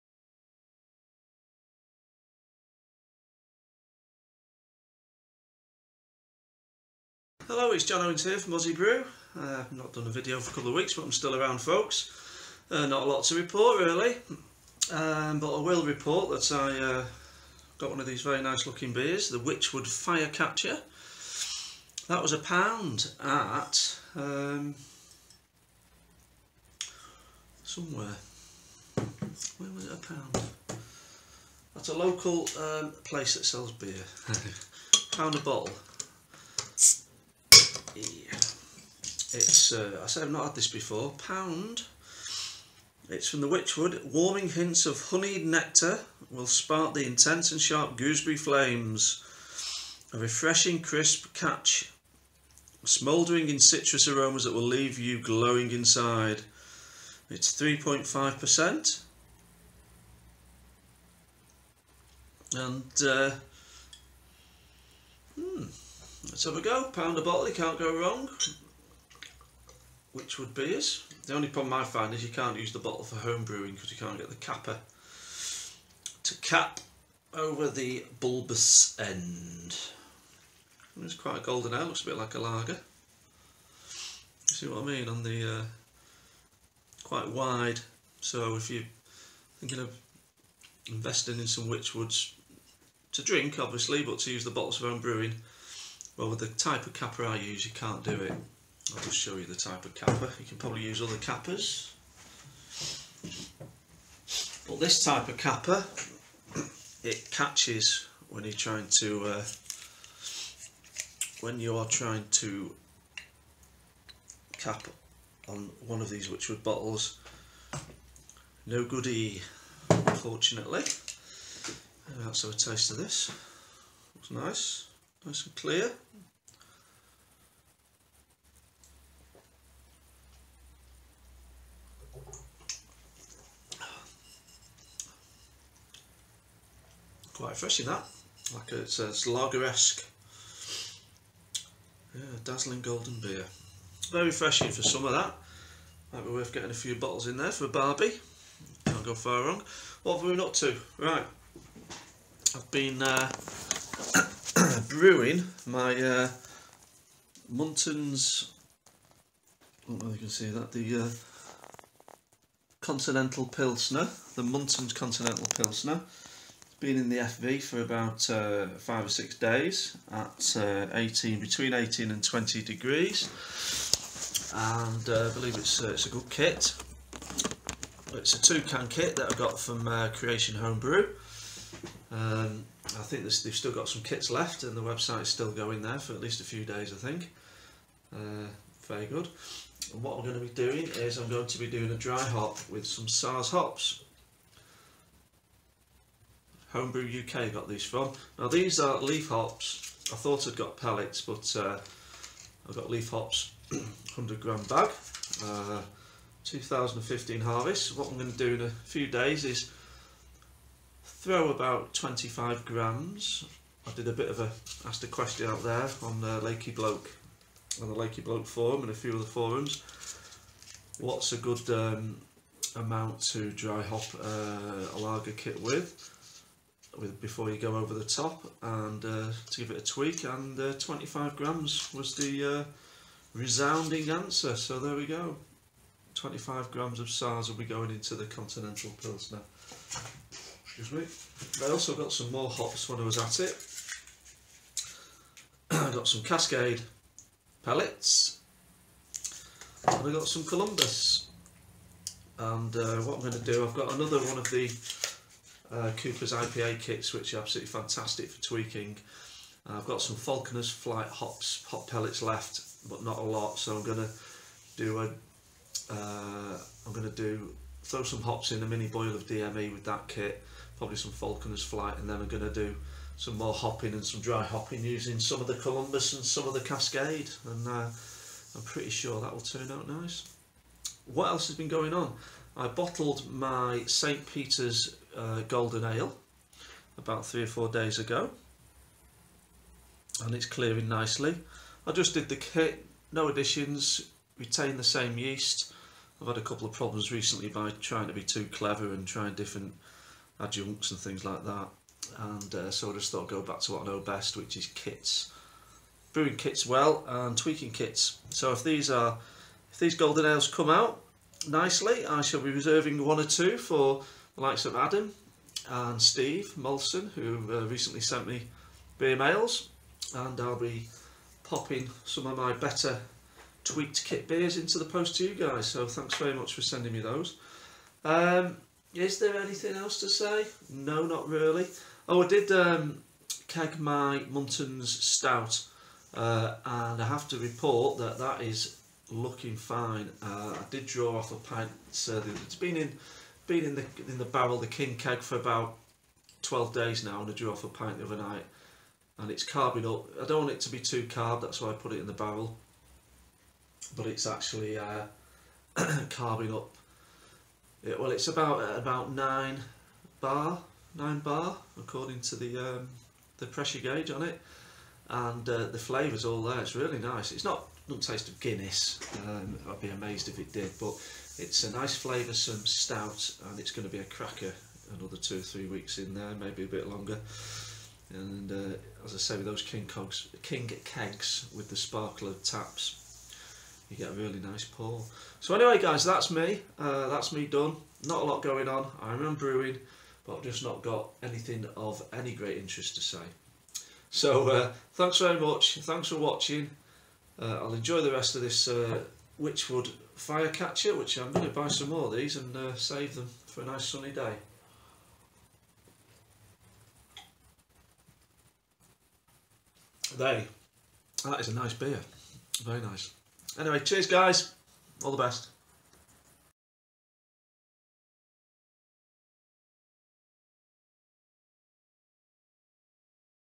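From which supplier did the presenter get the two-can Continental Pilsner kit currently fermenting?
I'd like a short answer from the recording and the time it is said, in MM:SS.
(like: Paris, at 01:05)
Creation Homebrew, at 03:00.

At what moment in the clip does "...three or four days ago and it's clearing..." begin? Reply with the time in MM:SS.
04:47.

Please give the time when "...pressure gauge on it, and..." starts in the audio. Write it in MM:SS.
06:03.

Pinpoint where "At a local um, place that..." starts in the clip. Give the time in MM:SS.
00:31.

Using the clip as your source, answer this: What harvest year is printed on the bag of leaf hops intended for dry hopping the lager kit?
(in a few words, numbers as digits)
2015.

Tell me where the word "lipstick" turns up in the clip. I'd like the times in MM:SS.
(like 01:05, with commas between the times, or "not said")
not said.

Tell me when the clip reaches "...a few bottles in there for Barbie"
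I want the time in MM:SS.
02:26.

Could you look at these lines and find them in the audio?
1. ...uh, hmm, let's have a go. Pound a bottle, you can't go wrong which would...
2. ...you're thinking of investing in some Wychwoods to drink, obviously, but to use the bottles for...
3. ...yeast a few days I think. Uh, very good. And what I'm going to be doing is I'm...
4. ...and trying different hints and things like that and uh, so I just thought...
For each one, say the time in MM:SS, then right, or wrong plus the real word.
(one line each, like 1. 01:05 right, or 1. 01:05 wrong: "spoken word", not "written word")
1. 01:03 right
2. 01:28 right
3. 03:06 wrong: "least", not "yeast"
4. 04:58 wrong: "adjuncts", not "hints".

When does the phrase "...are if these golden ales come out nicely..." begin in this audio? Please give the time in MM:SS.
05:08.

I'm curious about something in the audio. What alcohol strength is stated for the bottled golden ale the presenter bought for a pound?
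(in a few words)
3.5%.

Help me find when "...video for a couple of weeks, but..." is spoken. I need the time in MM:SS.
00:10.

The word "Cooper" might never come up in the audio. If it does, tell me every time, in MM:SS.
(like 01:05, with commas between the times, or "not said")
04:15.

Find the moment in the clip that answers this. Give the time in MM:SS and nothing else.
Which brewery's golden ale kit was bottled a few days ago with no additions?
04:43.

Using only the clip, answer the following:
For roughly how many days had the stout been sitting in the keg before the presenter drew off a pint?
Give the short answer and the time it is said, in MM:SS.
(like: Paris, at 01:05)
12, at 05:46.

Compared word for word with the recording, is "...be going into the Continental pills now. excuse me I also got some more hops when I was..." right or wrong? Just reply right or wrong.
right.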